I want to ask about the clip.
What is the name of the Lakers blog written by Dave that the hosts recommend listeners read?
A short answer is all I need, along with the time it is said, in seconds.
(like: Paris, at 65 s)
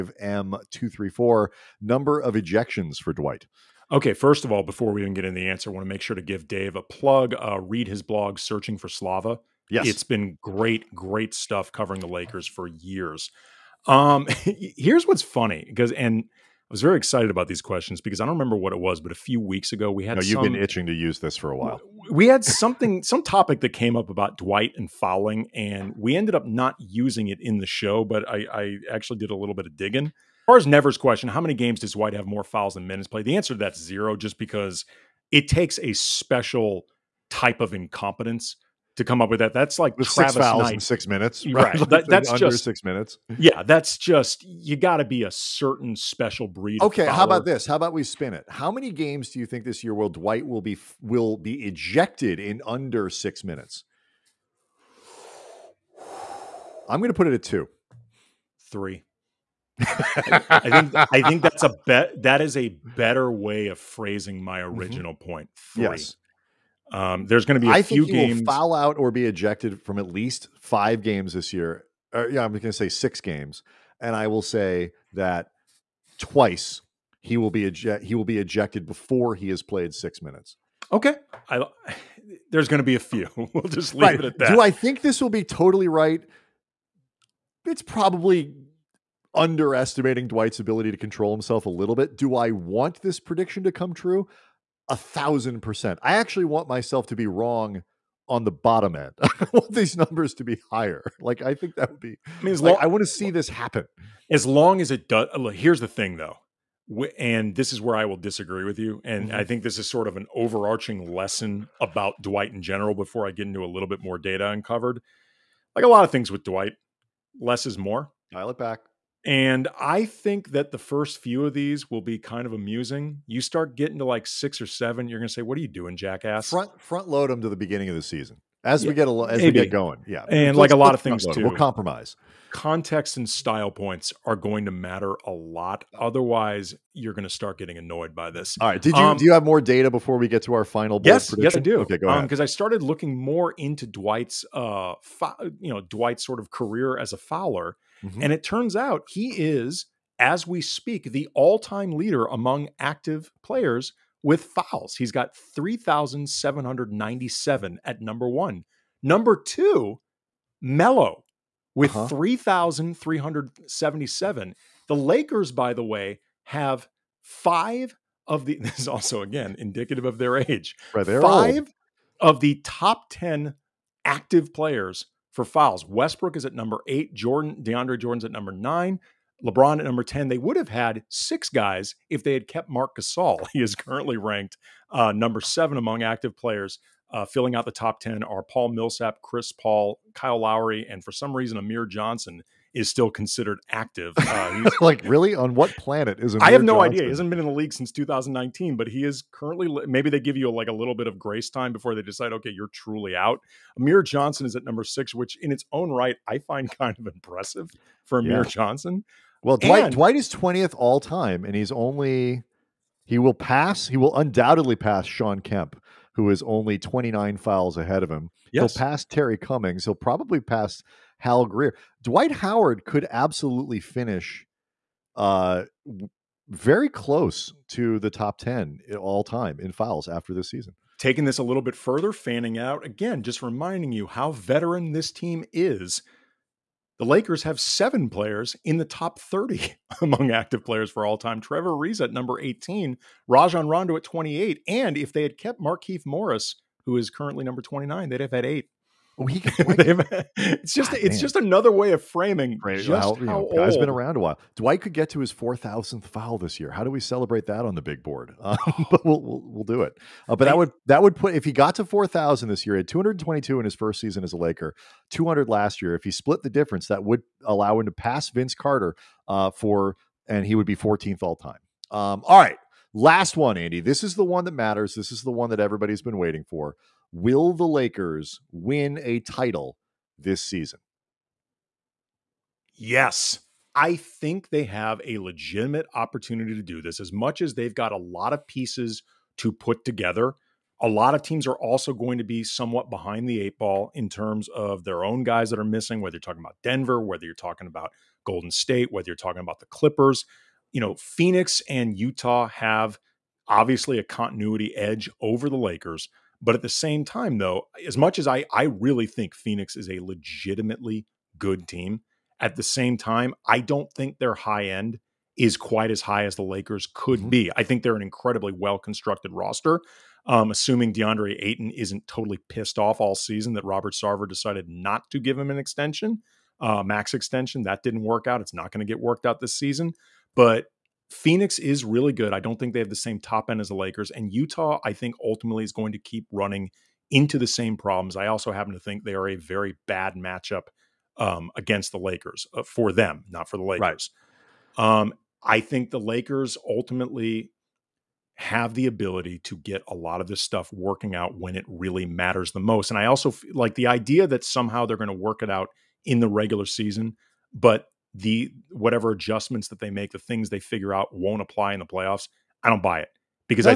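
Searching for Slava, at 8 s.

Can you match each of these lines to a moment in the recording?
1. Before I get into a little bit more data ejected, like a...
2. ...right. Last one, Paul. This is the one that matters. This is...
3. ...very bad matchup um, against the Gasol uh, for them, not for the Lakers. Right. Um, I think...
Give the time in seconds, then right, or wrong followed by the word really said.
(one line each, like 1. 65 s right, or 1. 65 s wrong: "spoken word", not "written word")
1. 112 s wrong: "uncovered", not "ejected"
2. 272 s wrong: "Andy", not "Paul"
3. 339 s wrong: "Lakers", not "Gasol".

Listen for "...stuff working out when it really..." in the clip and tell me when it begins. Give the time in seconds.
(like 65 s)
350 s.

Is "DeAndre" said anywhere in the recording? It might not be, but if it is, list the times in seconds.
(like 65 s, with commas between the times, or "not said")
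177 s, 320 s.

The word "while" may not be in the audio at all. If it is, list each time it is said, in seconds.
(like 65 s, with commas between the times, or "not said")
21 s, 254 s.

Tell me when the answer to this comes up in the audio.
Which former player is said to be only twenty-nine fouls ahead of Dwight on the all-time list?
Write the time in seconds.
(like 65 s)
215 s.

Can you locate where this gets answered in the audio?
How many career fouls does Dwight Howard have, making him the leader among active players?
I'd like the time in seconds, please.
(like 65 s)
155 s.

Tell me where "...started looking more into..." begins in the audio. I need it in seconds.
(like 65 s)
142 s.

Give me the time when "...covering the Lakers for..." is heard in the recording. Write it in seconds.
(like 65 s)
11 s.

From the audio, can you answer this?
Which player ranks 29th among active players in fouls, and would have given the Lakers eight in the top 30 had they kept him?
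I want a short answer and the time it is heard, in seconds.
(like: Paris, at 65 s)
Markieff Morris, at 245 s.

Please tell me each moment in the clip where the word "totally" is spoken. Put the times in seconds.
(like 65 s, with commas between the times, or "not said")
85 s, 322 s.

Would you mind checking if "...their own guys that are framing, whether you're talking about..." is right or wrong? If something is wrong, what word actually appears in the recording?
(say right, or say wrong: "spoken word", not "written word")
wrong: "missing", not "framing".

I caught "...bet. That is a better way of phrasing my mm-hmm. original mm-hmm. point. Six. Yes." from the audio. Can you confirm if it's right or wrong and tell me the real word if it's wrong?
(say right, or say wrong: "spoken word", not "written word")
wrong: "Three", not "Six".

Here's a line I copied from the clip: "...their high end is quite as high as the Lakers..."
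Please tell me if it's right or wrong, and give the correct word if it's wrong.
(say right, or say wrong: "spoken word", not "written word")
right.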